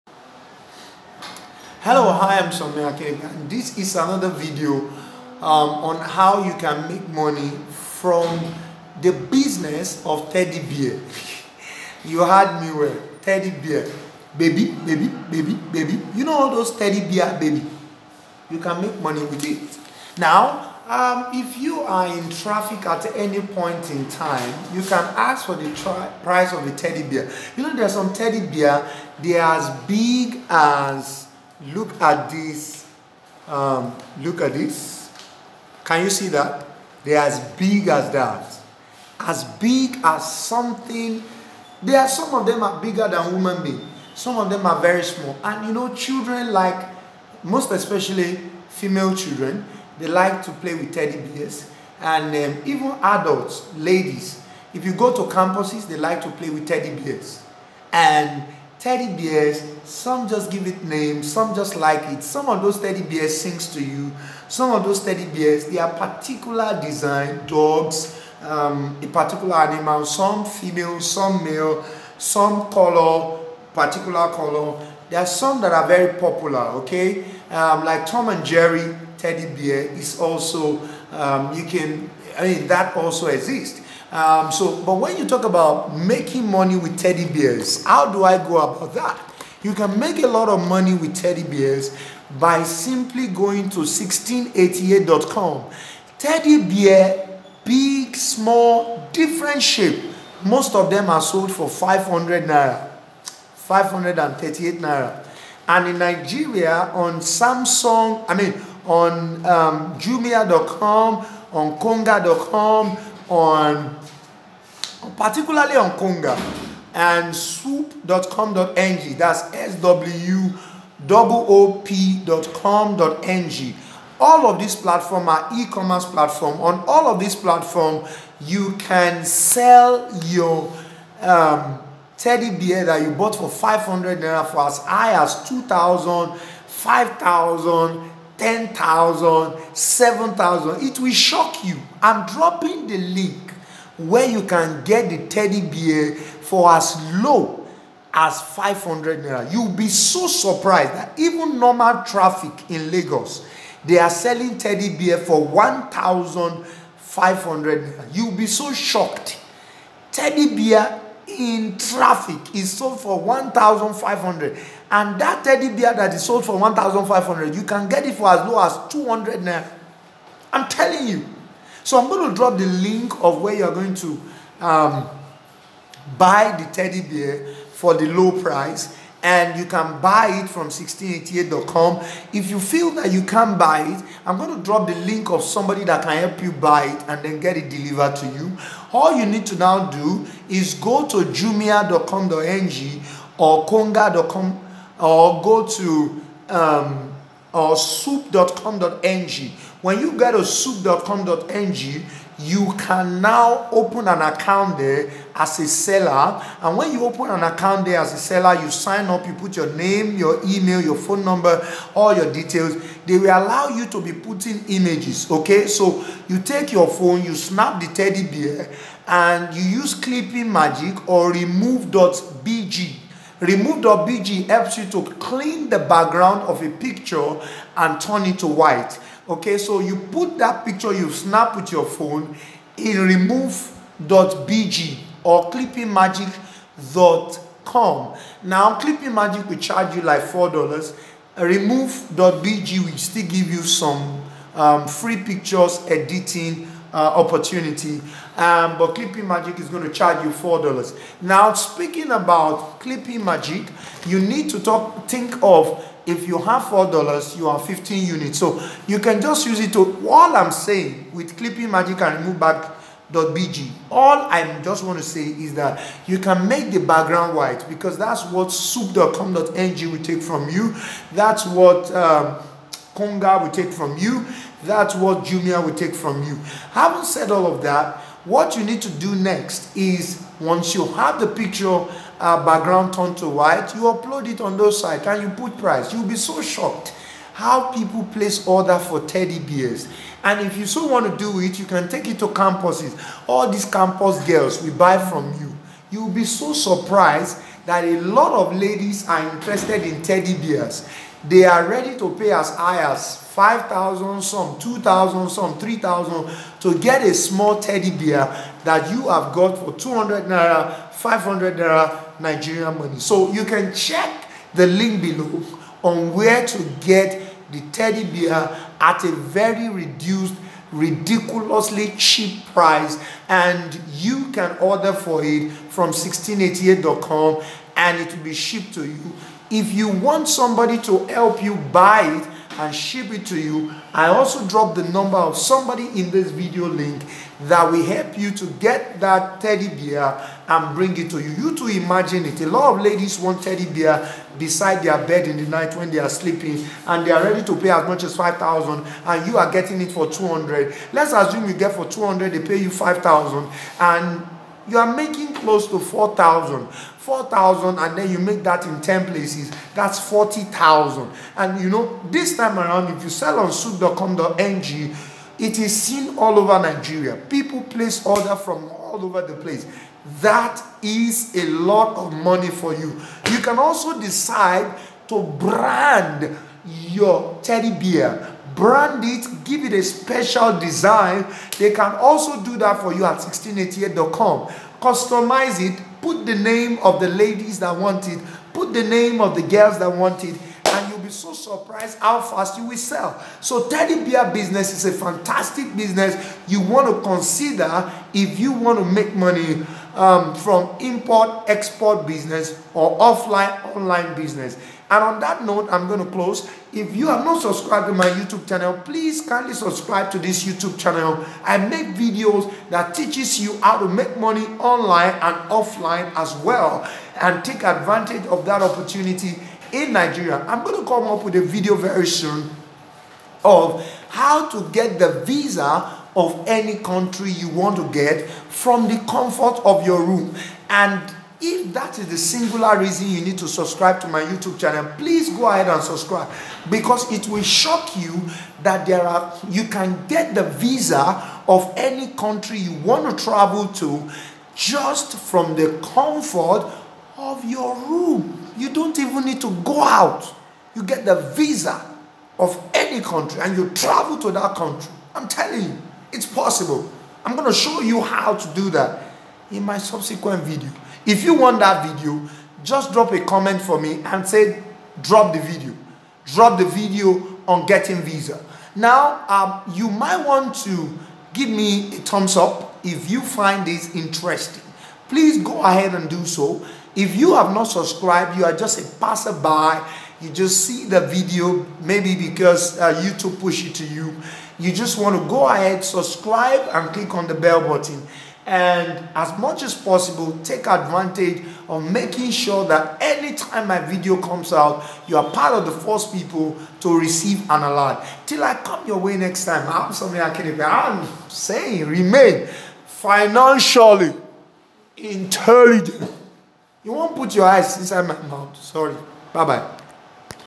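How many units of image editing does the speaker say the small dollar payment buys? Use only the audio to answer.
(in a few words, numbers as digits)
15.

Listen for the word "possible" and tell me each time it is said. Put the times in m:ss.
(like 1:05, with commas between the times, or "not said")
7:36, 8:09.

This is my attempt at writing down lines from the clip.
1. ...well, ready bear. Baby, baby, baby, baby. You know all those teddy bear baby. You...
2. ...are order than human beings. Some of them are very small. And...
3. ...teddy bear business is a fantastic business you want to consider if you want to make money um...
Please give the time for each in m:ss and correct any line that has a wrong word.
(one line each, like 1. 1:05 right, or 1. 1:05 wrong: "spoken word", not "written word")
1. 0:12 wrong: "teddy", not "ready"
2. 0:42 wrong: "bigger", not "order"
3. 6:33 right.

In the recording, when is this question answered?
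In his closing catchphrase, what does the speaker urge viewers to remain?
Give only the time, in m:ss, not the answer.
8:22.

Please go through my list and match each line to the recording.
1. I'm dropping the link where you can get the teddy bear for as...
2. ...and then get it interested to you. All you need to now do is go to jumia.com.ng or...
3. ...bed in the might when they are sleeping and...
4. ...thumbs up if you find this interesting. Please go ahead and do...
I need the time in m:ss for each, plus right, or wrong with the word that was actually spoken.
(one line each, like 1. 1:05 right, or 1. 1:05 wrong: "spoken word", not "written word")
1. 2:22 right
2. 3:07 wrong: "delivered", not "interested"
3. 5:45 wrong: "night", not "might"
4. 7:51 right.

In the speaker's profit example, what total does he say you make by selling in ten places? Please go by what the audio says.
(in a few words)
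40,000.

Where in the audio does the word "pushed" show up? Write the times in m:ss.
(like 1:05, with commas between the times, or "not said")
8:03.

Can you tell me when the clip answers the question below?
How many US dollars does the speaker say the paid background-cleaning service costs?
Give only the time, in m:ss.
4:00.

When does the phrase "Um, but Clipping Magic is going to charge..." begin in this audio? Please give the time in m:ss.
4:08.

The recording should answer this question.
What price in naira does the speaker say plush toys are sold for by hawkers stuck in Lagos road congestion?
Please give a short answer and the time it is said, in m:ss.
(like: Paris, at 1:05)
1,500 naira, at 2:35.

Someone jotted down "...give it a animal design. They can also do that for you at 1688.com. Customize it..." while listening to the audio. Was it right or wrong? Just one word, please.
wrong.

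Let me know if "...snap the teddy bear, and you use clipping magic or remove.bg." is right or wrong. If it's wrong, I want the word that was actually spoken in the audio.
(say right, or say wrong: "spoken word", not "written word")
right.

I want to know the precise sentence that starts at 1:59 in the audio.
That's S W O O P.com.ng.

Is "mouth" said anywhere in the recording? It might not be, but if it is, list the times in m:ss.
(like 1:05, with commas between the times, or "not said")
8:28.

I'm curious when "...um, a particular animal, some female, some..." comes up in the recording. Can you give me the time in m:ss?
1:08.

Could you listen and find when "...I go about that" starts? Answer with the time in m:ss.
1:28.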